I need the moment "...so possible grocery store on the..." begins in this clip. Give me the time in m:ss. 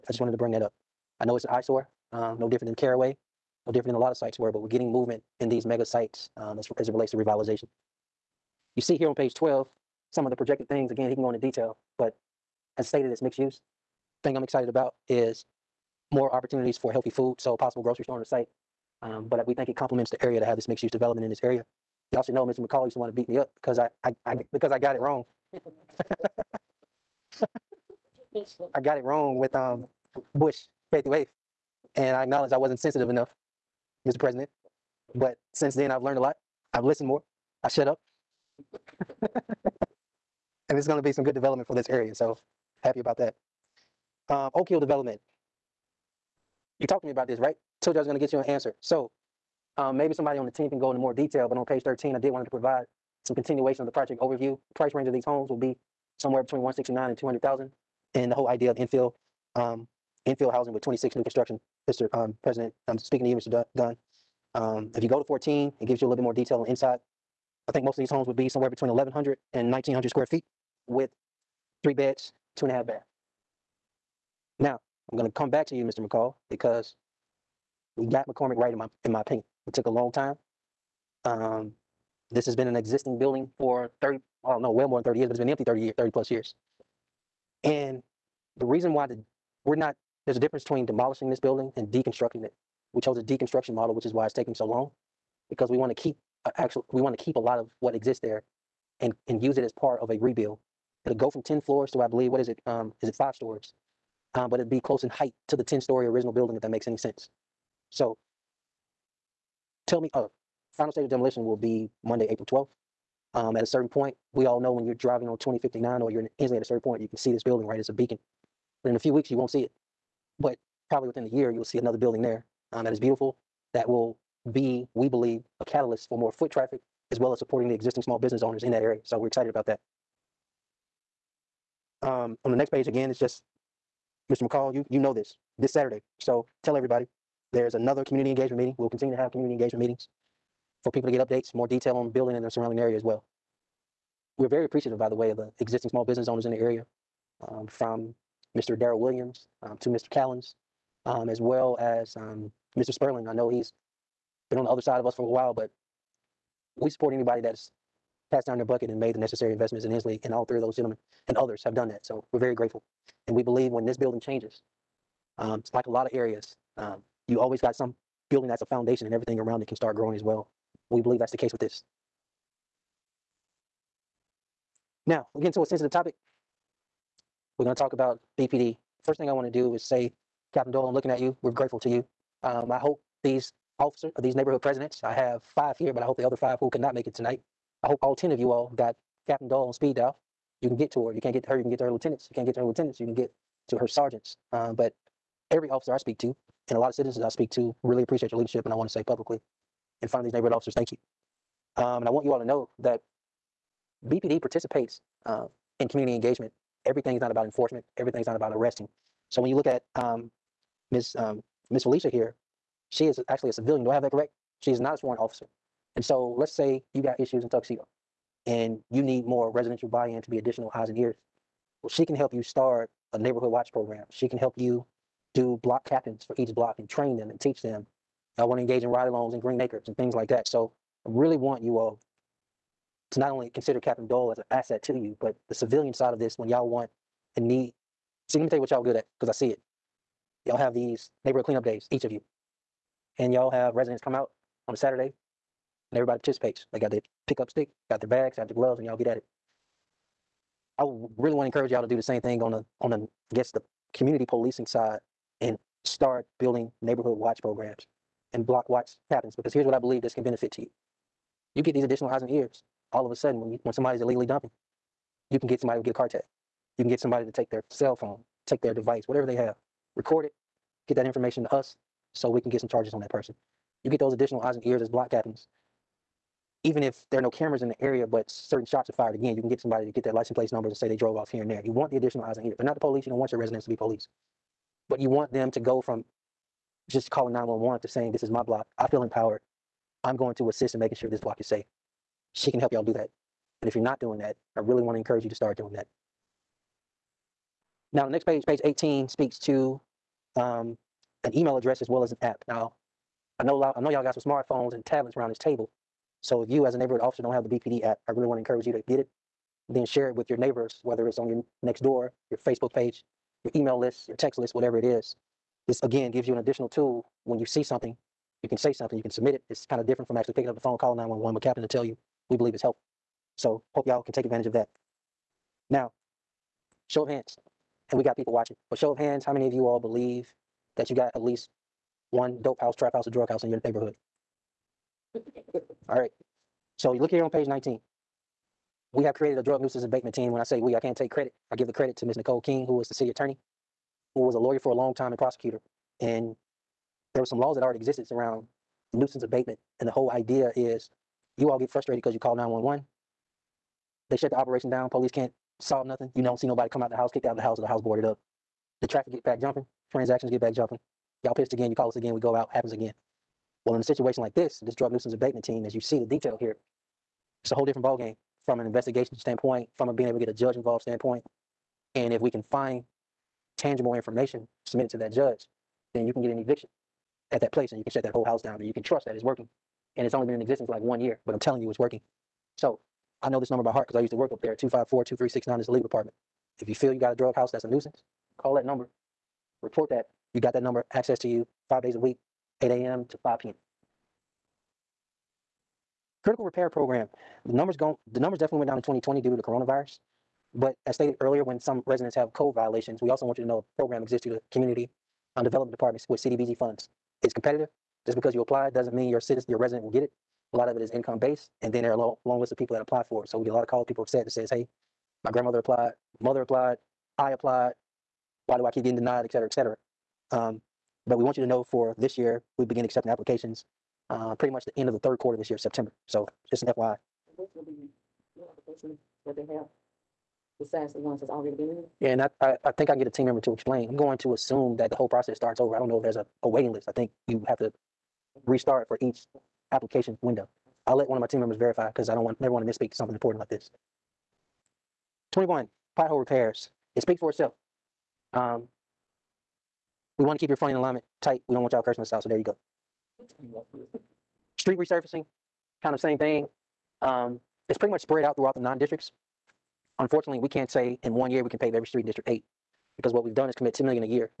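0:17.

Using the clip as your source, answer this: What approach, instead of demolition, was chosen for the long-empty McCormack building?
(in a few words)
deconstruction.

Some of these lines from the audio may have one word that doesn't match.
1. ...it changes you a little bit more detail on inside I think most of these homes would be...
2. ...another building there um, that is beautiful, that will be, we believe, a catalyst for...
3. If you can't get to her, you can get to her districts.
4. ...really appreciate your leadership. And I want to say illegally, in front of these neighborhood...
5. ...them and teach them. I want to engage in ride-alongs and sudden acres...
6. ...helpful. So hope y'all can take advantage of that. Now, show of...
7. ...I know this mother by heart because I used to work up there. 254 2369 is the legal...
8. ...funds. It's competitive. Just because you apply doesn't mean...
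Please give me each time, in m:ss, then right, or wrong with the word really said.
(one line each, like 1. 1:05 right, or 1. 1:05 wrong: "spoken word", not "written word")
1. 1:05 wrong: "gives", not "changes"
2. 2:01 right
3. 3:11 wrong: "lieutenants", not "districts"
4. 3:17 wrong: "publicly", not "illegally"
5. 3:47 wrong: "green", not "sudden"
6. 5:22 right
7. 6:23 wrong: "number", not "mother"
8. 6:46 right.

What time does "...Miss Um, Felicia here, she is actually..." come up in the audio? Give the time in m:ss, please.
3:30.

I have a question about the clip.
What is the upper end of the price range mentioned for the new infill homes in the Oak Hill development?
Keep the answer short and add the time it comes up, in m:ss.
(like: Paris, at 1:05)
200,000, at 0:57.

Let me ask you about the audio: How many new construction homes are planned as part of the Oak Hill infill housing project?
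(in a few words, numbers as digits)
26.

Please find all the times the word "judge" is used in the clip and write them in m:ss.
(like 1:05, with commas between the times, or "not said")
6:10, 6:15.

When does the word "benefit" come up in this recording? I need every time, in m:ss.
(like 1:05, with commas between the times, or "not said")
4:20.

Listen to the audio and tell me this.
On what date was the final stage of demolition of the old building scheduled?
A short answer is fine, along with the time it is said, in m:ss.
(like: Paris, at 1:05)
Monday, April 12th, at 1:52.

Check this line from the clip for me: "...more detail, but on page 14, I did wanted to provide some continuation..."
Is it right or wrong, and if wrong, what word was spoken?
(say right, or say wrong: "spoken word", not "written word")
wrong: "13", not "14".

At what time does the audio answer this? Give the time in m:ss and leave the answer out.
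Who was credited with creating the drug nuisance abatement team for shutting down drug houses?
5:42.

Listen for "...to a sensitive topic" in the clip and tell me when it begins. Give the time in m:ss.
2:55.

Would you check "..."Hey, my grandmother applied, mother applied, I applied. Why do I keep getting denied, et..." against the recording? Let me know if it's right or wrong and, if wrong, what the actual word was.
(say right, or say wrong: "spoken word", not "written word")
right.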